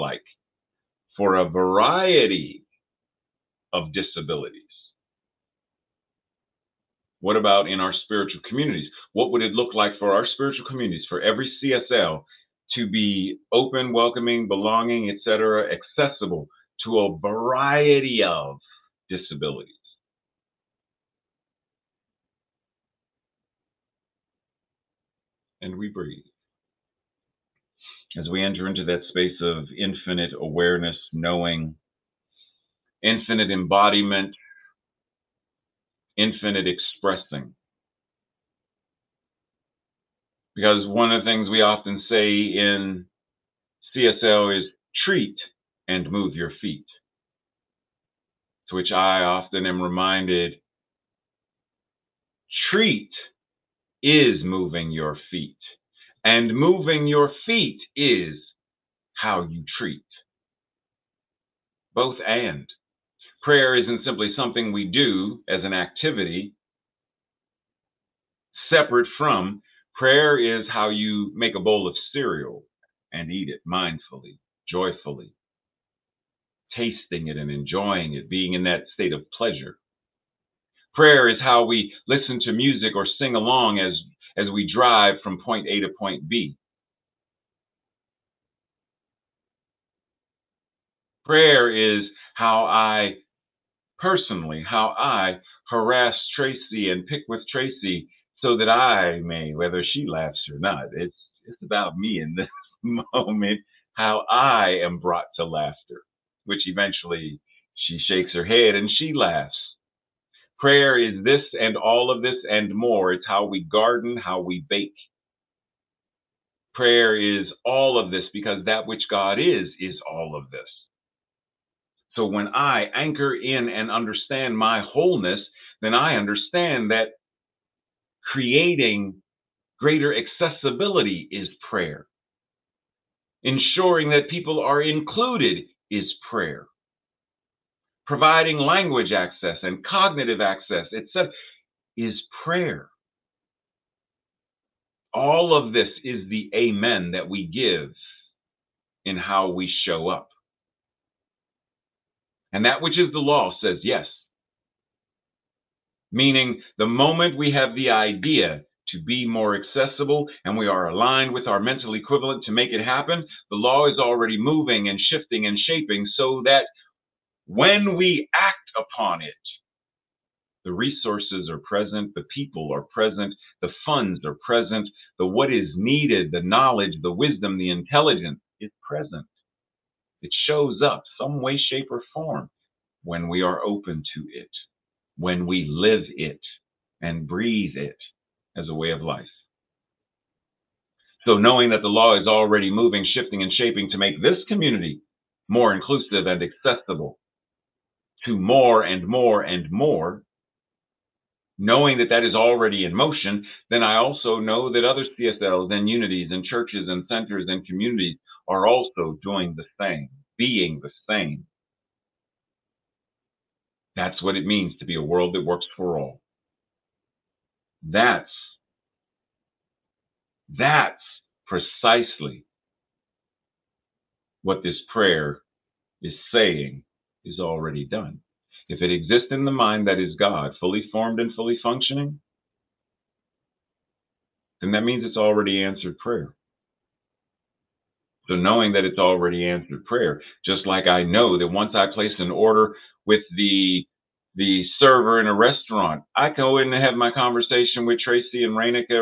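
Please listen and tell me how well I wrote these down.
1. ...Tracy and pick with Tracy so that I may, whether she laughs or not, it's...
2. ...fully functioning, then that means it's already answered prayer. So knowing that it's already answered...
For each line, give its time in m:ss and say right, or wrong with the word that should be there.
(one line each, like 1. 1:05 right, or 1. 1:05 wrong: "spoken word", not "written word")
1. 1:36 right
2. 3:51 right.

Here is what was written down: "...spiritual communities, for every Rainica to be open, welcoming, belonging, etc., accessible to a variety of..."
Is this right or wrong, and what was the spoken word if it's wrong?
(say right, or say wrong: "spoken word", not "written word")
wrong: "CSL", not "Rainica".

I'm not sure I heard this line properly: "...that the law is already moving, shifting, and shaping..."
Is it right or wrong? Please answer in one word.
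right.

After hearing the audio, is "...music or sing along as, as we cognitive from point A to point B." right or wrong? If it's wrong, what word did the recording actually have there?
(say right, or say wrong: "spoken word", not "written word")
wrong: "drive", not "cognitive".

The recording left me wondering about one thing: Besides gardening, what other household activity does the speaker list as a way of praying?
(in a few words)
bake.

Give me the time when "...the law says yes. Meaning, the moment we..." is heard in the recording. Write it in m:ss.
2:33.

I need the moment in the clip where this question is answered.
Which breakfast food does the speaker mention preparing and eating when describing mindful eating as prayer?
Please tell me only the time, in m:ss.
1:12.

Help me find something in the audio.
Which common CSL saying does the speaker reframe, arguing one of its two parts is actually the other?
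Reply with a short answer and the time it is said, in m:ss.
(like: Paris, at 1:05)
treat and move your feet, at 0:45.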